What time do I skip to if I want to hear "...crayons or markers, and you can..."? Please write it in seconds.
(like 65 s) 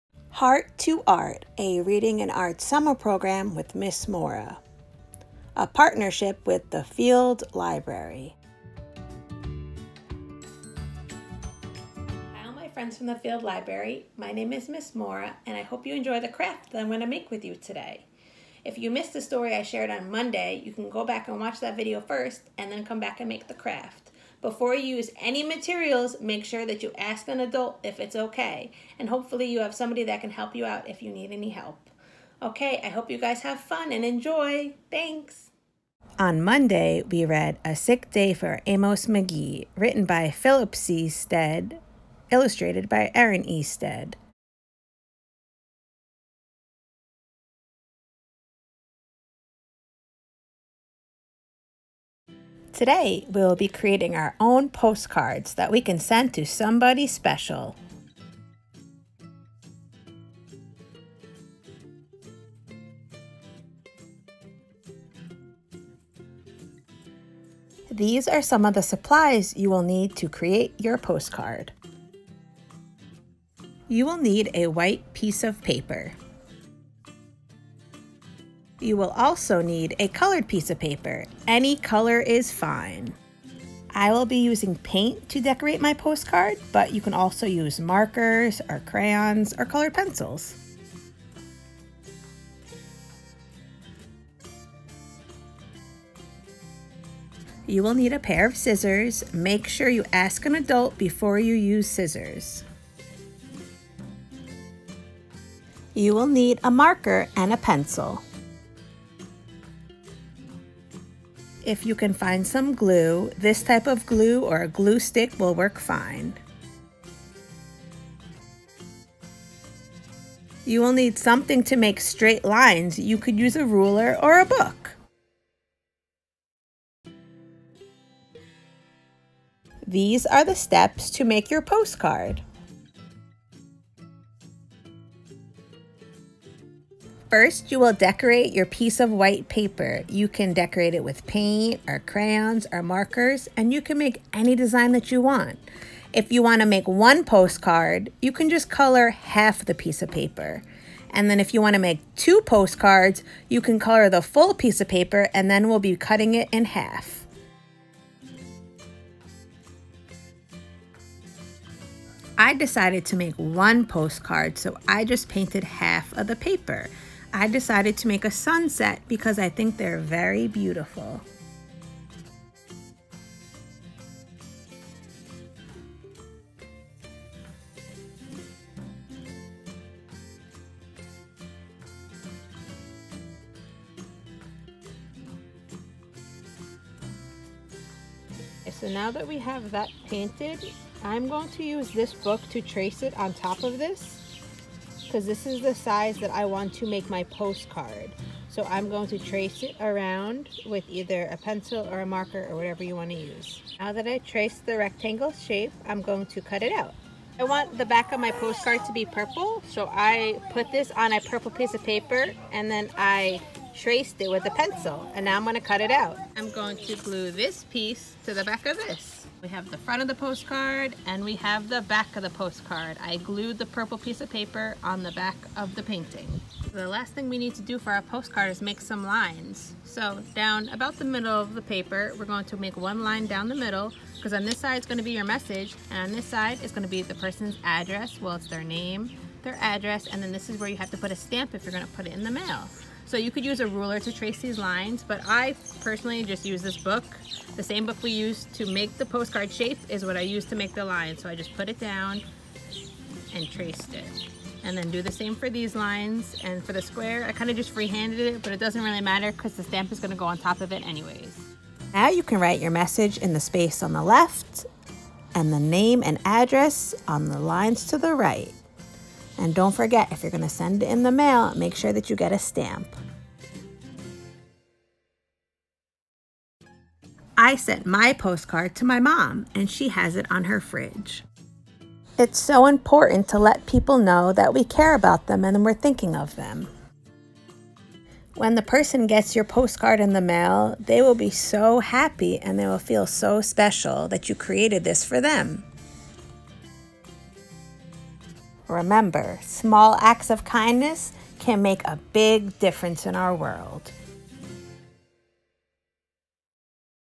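141 s.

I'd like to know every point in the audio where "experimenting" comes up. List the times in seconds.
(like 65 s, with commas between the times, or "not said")
not said.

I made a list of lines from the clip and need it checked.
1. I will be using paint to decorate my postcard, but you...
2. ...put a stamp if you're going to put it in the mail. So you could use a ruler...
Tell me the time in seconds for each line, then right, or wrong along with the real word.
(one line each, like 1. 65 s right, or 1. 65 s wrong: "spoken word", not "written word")
1. 83 s right
2. 240 s right.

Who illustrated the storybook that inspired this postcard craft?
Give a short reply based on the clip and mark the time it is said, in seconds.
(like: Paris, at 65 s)
Erin E. Stead, at 43 s.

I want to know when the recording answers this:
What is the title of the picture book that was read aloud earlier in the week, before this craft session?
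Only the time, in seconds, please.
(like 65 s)
37 s.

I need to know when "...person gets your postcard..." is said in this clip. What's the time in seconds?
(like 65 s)
288 s.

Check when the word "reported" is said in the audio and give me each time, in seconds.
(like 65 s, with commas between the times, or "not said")
not said.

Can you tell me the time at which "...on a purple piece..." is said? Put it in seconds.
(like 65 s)
210 s.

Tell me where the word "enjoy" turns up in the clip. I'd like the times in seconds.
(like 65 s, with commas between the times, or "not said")
15 s, 34 s.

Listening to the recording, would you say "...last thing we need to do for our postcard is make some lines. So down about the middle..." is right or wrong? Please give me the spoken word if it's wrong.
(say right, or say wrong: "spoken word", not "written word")
right.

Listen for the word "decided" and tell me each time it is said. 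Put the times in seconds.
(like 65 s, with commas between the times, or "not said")
162 s, 167 s.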